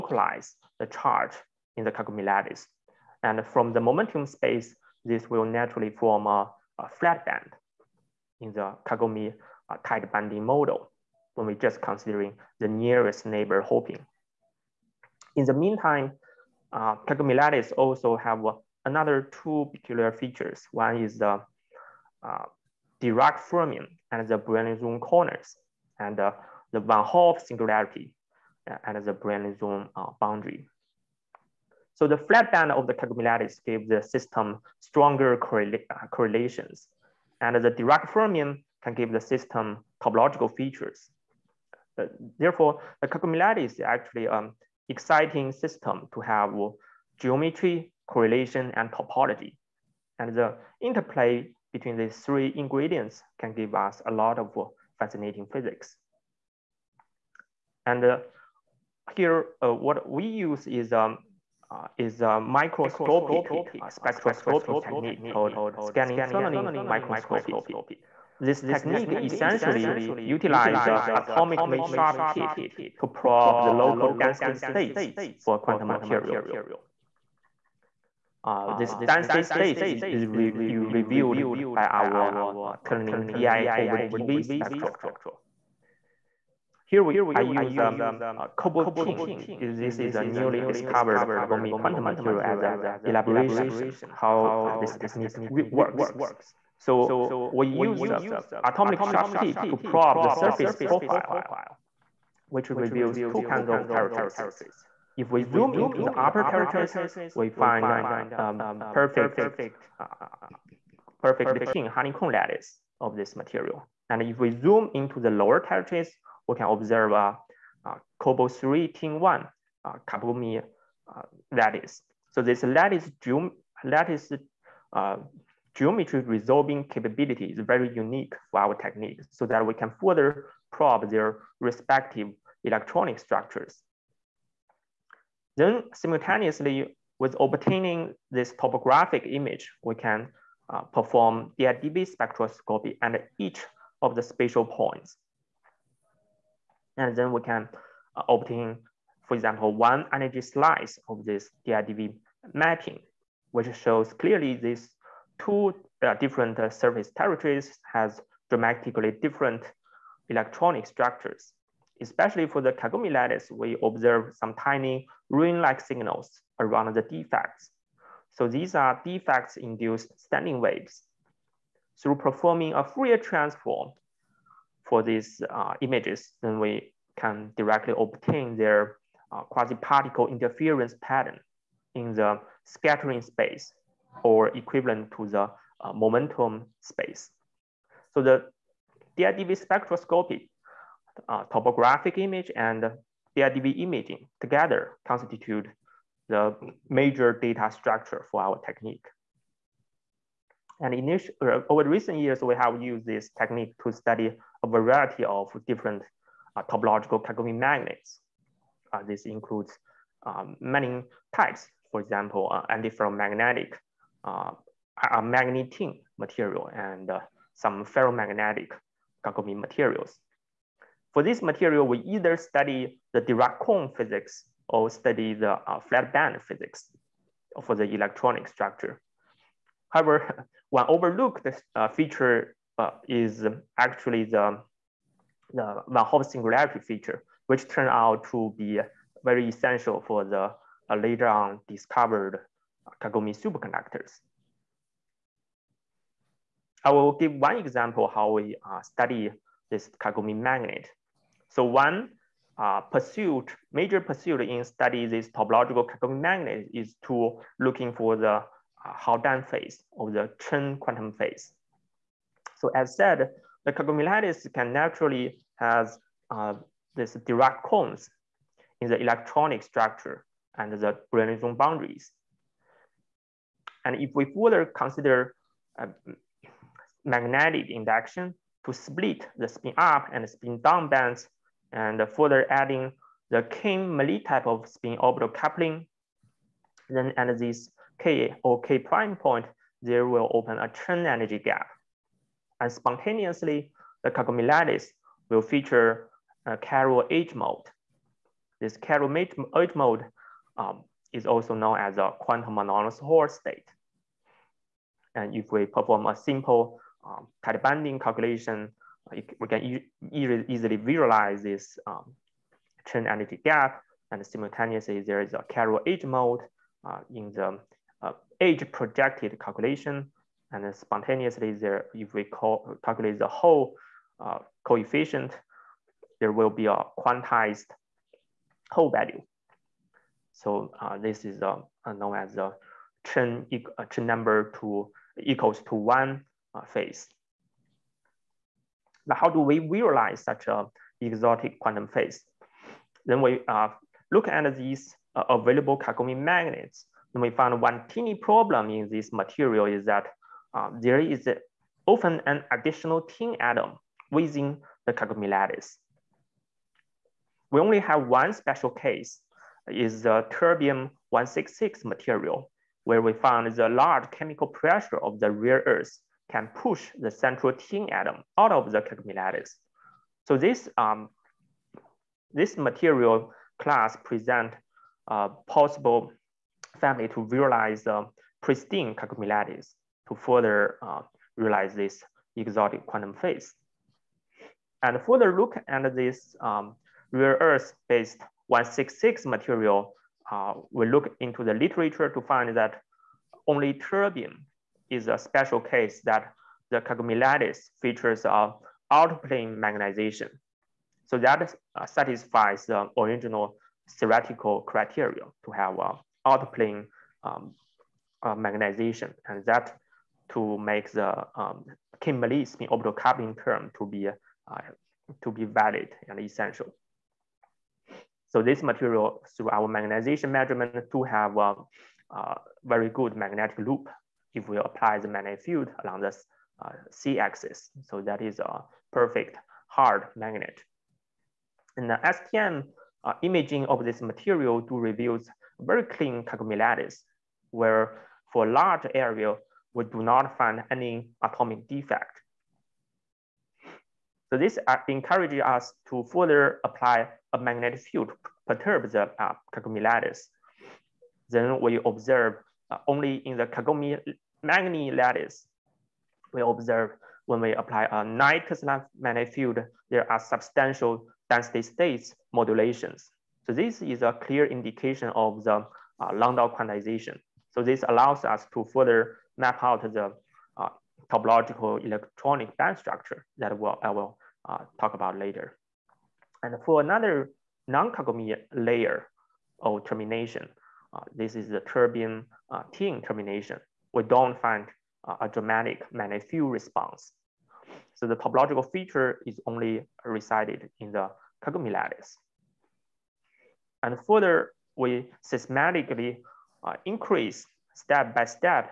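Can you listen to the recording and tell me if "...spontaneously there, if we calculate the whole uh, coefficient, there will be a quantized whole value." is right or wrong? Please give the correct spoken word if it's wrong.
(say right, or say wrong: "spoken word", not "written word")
right.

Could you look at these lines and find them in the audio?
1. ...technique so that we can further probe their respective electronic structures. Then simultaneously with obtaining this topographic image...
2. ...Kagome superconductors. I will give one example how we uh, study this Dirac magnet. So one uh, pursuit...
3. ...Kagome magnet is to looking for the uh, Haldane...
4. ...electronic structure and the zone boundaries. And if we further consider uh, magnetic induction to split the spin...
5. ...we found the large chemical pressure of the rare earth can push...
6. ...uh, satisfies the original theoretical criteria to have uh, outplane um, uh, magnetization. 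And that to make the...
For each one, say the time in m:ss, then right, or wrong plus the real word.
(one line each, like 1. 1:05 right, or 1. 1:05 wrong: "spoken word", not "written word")
1. 2:08 right
2. 4:03 wrong: "Kagome", not "Dirac"
3. 4:15 right
4. 4:29 right
5. 6:03 right
6. 6:41 right.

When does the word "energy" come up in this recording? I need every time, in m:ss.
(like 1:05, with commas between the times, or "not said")
2:30, 4:51, 5:13.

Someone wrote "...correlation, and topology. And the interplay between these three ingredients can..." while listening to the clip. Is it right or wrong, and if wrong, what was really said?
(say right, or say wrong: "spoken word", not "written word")
right.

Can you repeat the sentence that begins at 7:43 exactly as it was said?
So this is a clear indication of the uh, Landau quantization.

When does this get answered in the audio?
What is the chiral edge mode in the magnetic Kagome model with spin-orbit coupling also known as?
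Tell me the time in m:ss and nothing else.
5:02.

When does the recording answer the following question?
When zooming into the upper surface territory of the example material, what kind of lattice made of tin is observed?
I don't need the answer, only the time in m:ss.
1:51.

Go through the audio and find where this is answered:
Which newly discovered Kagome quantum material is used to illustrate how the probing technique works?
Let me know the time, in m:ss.
1:28.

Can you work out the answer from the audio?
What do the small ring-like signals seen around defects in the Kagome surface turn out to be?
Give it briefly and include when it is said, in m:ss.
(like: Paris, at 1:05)
standing waves, at 2:50.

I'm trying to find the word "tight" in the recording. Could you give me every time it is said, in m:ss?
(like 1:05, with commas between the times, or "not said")
0:09, 5:07.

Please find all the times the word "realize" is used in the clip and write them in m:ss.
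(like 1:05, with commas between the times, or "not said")
5:39, 6:17, 6:21.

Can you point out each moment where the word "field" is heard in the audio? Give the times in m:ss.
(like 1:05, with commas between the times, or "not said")
7:05, 7:27, 7:39, 8:06.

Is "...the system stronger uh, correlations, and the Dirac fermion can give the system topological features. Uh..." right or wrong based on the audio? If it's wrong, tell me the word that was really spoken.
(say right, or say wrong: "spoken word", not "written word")
right.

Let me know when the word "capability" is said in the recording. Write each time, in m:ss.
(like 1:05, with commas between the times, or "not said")
2:06.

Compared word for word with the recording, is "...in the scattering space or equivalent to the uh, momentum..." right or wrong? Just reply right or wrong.
right.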